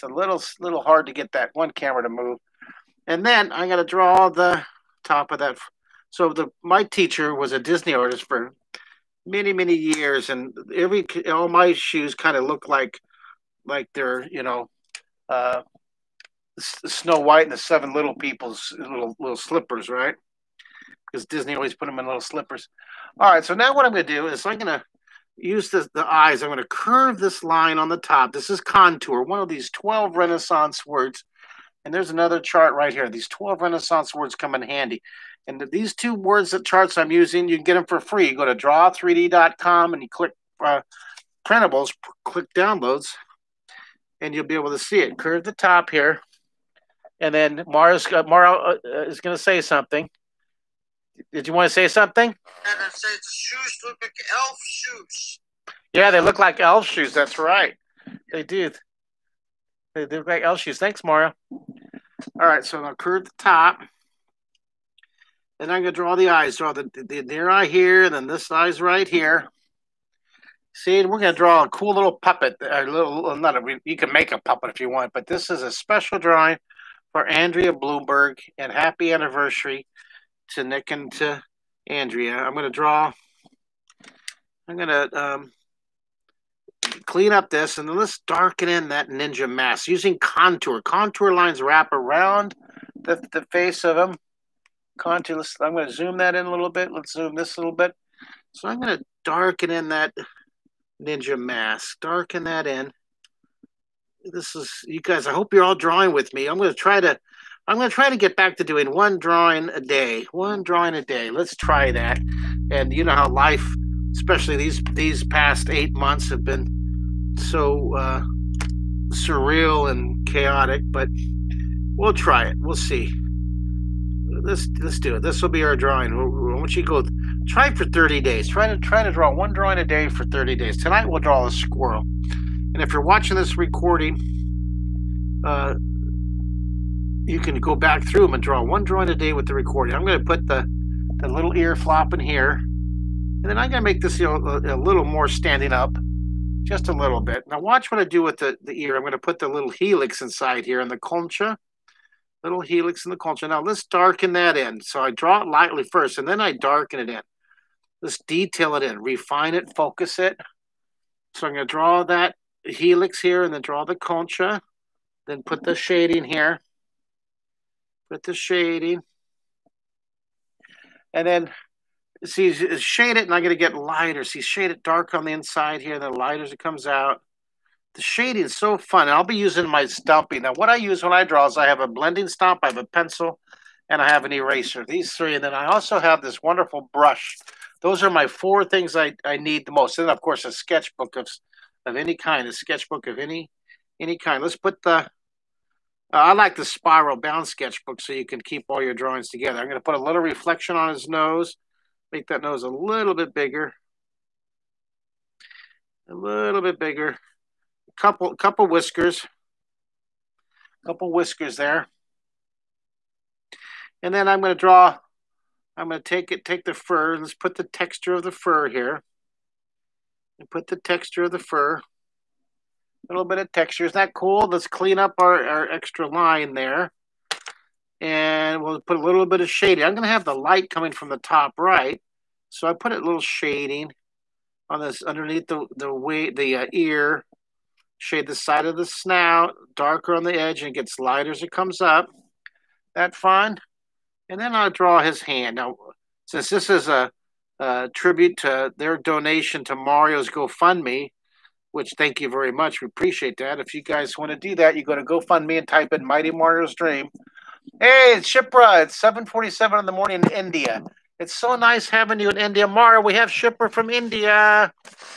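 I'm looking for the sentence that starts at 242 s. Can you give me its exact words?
That fine, and then I'll draw his hand.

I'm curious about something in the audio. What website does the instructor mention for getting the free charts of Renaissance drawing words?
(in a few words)
draw3d.com.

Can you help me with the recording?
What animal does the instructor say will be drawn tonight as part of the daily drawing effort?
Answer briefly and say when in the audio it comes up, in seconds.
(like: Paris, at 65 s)
squirrel, at 131 s.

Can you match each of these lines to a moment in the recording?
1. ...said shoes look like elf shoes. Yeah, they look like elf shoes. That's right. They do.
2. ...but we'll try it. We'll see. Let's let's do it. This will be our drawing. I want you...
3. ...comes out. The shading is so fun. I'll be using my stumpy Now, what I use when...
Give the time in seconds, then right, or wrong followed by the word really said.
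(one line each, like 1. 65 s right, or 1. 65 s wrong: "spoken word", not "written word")
1. 52 s right
2. 120 s right
3. 176 s right.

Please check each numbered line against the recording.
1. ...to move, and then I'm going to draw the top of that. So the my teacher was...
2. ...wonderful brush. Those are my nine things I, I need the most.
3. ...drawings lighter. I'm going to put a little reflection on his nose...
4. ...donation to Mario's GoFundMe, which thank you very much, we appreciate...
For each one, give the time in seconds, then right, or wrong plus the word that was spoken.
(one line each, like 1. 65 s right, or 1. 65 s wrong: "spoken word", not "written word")
1. 2 s right
2. 186 s wrong: "four", not "nine"
3. 198 s wrong: "together", not "lighter"
4. 248 s right.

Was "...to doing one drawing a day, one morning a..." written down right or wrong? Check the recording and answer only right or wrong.
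wrong.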